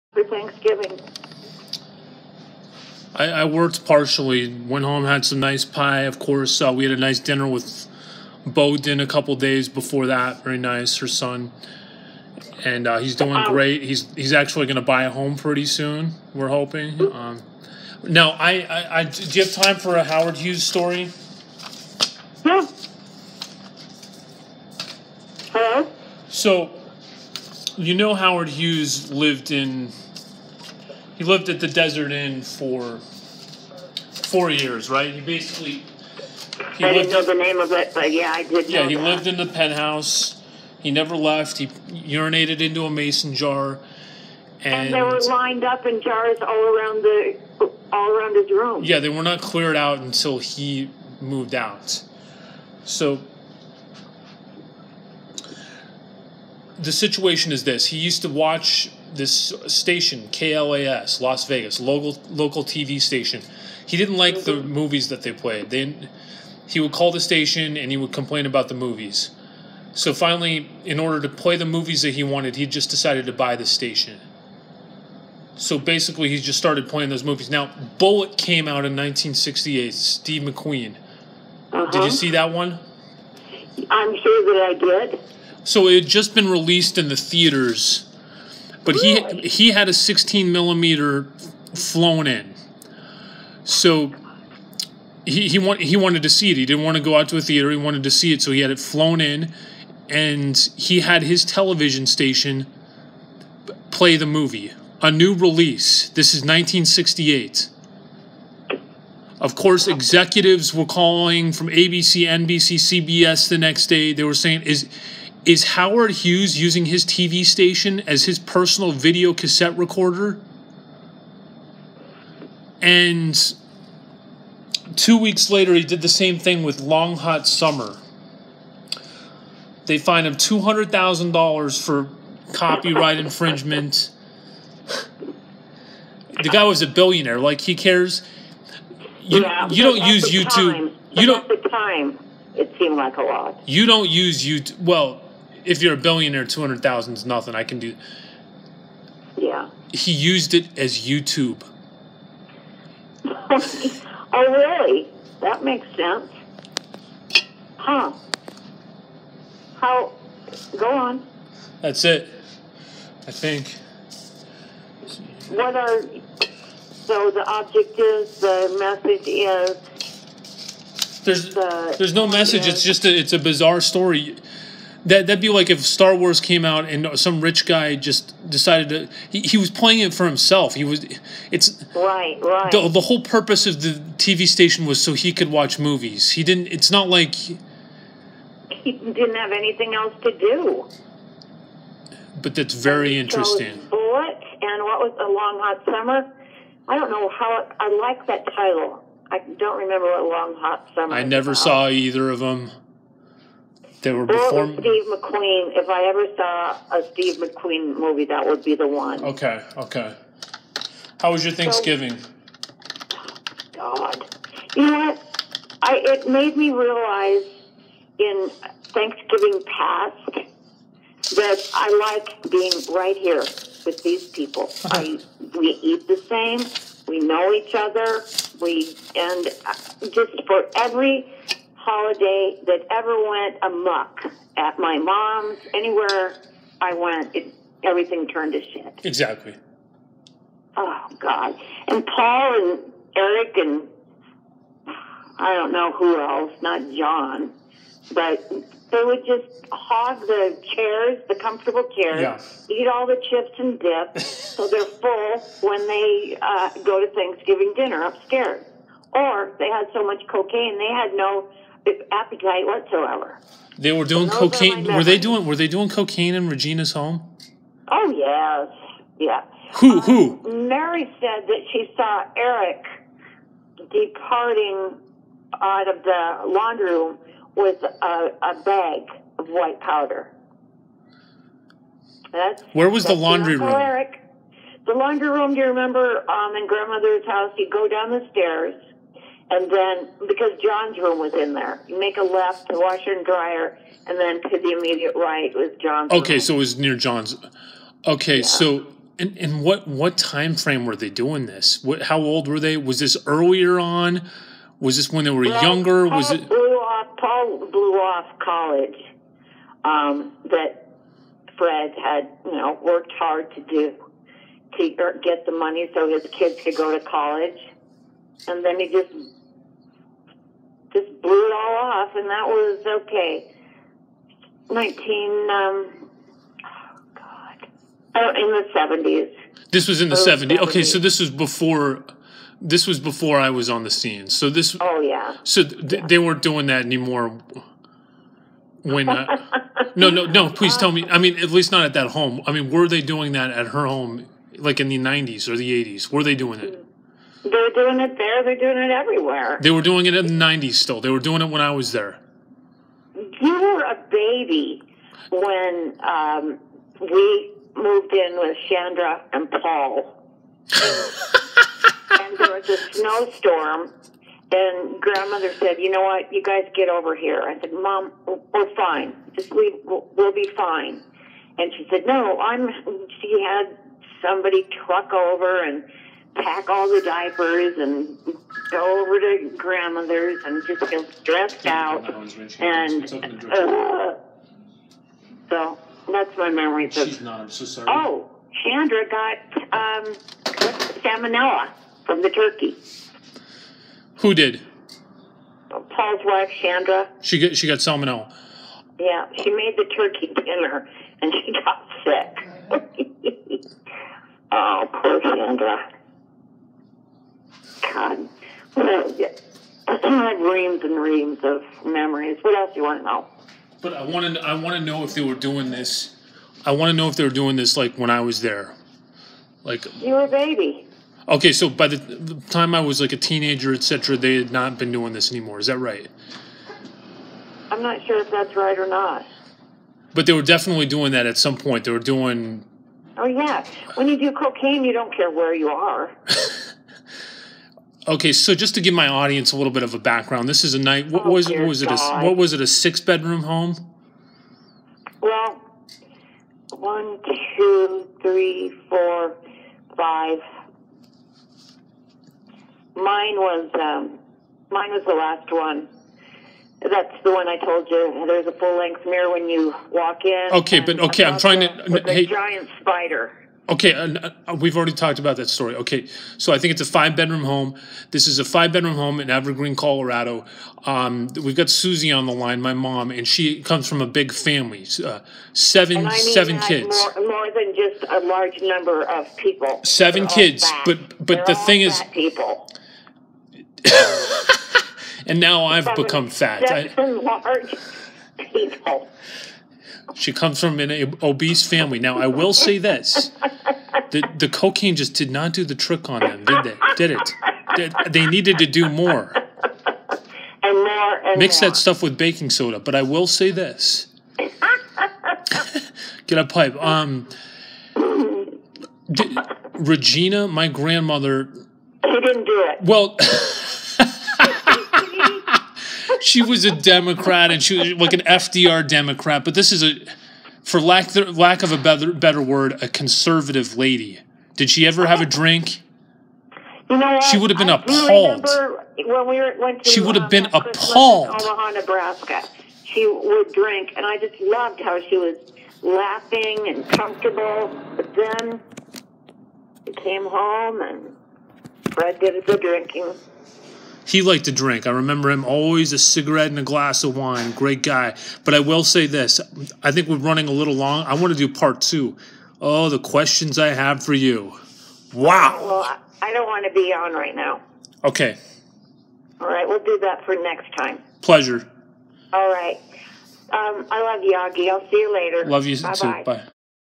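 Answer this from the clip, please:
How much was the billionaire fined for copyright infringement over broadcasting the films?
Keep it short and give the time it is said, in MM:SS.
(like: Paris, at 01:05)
$200,000, at 02:10.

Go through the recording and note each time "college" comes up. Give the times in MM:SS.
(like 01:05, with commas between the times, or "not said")
05:08, 05:17.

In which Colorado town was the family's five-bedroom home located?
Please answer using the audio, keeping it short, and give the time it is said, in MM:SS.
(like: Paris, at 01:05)
Evergreen, at 07:49.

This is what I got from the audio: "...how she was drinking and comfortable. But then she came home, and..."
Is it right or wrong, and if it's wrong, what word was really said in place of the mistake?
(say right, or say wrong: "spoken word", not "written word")
wrong: "laughing", not "drinking".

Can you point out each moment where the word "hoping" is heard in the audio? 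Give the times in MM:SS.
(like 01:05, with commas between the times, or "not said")
00:16.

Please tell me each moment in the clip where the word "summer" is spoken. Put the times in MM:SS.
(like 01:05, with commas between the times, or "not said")
02:07, 03:15, 03:20.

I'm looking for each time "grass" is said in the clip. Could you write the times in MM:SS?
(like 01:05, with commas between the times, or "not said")
not said.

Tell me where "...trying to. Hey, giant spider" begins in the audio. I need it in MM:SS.
07:41.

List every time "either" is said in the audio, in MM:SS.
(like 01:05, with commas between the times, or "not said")
03:21.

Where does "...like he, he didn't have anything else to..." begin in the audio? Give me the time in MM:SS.
03:07.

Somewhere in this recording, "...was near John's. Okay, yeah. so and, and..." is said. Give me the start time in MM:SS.
04:56.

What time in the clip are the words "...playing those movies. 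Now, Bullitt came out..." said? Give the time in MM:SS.
01:16.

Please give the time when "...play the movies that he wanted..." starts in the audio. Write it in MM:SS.
01:11.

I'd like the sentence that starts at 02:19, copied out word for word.
You, yeah, you don't use YouTube.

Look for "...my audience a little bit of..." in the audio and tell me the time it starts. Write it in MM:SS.
07:18.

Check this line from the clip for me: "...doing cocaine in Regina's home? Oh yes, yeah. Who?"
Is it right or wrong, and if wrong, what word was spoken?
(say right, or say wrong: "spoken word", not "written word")
right.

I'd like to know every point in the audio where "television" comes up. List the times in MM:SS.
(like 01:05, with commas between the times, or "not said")
01:41.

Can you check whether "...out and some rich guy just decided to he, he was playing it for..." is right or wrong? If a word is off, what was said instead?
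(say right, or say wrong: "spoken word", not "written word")
right.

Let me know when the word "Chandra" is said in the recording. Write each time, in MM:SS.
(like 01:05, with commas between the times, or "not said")
05:58, 06:28, 06:36, 06:45.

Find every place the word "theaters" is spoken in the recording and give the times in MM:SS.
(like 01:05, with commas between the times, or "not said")
01:27, 01:37.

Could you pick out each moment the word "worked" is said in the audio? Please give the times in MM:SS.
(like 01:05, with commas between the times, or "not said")
00:03, 05:12.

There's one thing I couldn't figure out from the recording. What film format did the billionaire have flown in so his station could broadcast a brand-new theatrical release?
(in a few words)
16 millimeter.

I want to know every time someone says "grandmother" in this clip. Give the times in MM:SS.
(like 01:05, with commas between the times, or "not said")
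04:46, 06:05, 06:19, 08:30.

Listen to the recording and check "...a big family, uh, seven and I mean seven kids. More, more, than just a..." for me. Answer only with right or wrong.
right.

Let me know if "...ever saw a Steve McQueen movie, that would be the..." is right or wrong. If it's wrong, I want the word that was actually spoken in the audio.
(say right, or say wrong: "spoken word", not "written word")
right.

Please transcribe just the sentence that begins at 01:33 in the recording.
So he he, want, he wanted to see it.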